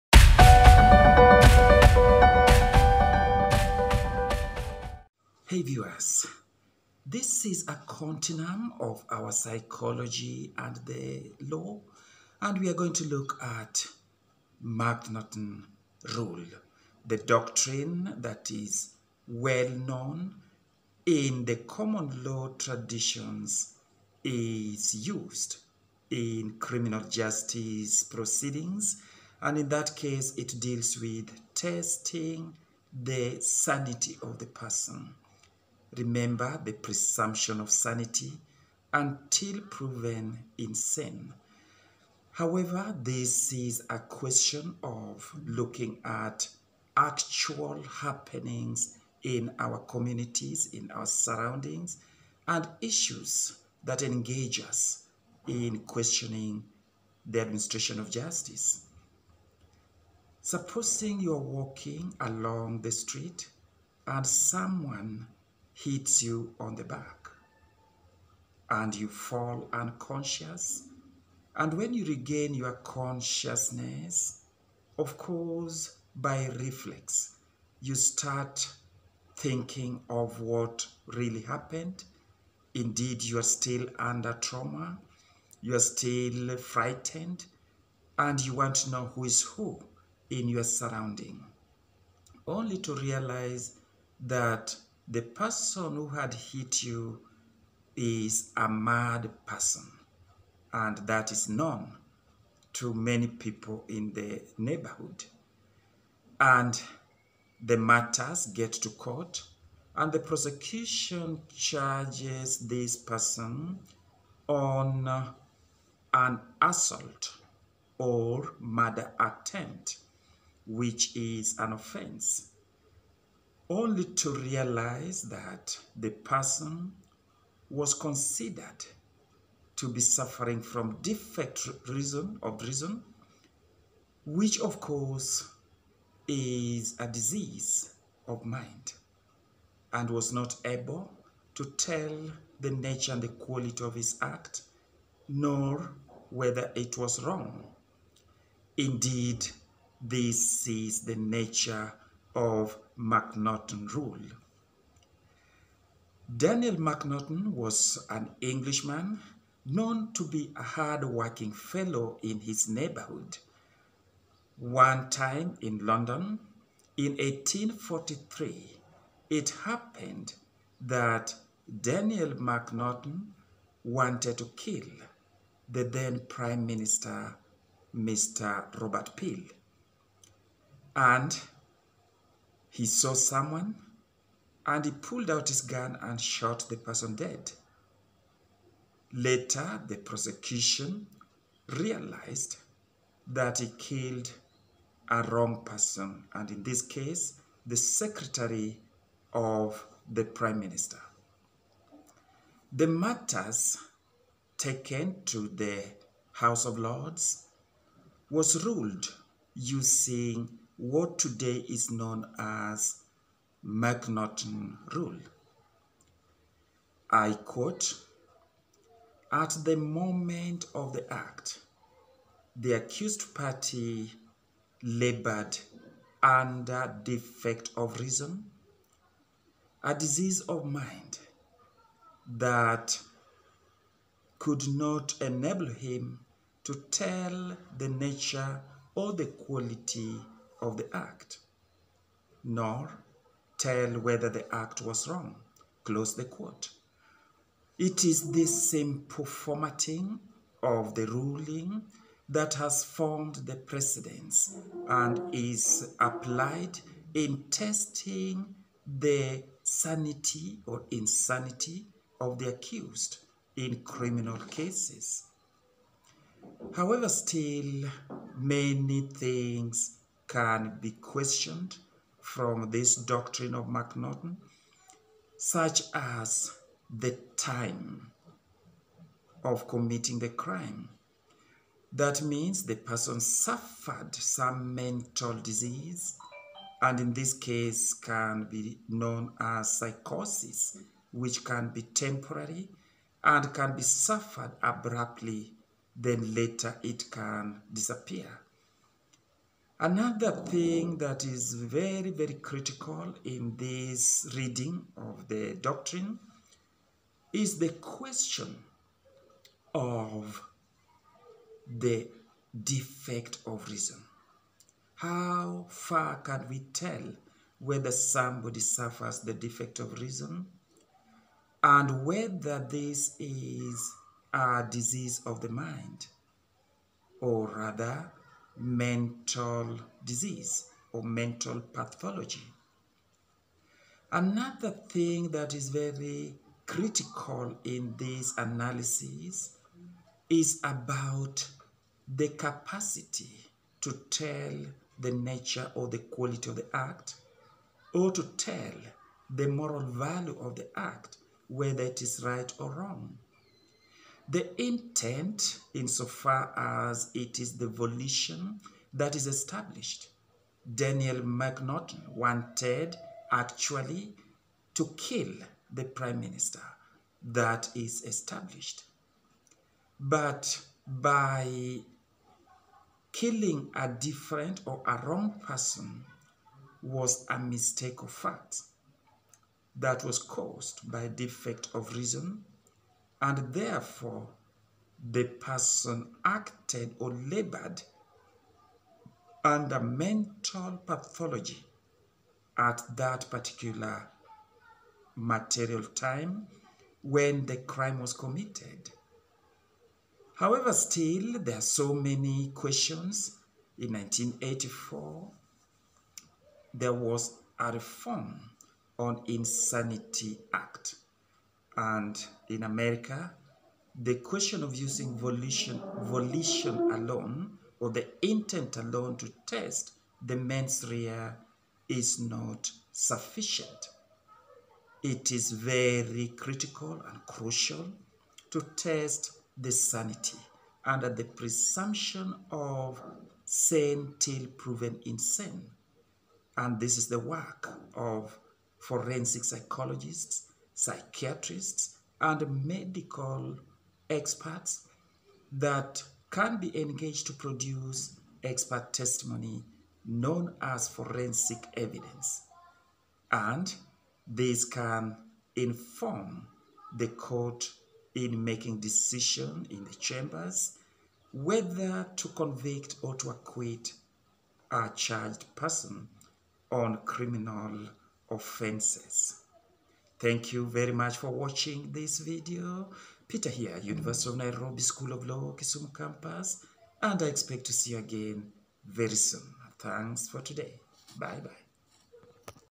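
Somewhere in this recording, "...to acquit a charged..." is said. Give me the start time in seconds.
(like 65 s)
463 s.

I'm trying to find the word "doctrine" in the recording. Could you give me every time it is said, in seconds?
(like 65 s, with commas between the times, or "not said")
17 s, 272 s, 305 s.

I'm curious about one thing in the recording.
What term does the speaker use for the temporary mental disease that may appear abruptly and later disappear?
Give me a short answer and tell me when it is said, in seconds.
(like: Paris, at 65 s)
psychosis, at 289 s.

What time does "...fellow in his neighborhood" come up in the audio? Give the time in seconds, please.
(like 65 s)
161 s.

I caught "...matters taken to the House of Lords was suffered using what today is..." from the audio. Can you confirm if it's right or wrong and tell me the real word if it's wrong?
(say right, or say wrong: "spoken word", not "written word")
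wrong: "ruled", not "suffered".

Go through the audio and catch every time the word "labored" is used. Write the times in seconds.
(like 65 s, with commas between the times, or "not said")
224 s, 387 s.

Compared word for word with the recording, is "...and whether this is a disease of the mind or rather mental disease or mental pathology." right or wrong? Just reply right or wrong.
right.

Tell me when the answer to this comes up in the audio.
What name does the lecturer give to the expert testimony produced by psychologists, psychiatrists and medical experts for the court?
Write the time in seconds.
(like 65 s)
450 s.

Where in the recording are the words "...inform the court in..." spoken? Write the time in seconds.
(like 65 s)
455 s.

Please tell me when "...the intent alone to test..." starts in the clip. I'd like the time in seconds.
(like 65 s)
417 s.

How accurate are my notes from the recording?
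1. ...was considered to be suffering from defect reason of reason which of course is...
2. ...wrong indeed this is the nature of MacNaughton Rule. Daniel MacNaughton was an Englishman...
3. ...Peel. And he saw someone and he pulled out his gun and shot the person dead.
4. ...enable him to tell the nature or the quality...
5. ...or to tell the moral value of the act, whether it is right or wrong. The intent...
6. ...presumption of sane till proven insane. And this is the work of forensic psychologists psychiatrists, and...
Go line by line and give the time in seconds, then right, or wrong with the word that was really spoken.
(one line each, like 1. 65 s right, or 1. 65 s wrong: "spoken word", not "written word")
1. 127 s right
2. 147 s right
3. 179 s right
4. 235 s right
5. 347 s right
6. 431 s right.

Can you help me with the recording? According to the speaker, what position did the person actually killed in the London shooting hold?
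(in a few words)
Secretary of the prime minister.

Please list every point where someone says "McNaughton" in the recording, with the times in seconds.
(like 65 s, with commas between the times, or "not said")
361 s.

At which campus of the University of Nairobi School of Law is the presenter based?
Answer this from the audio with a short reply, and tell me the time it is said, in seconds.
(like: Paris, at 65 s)
Kisumu, at 475 s.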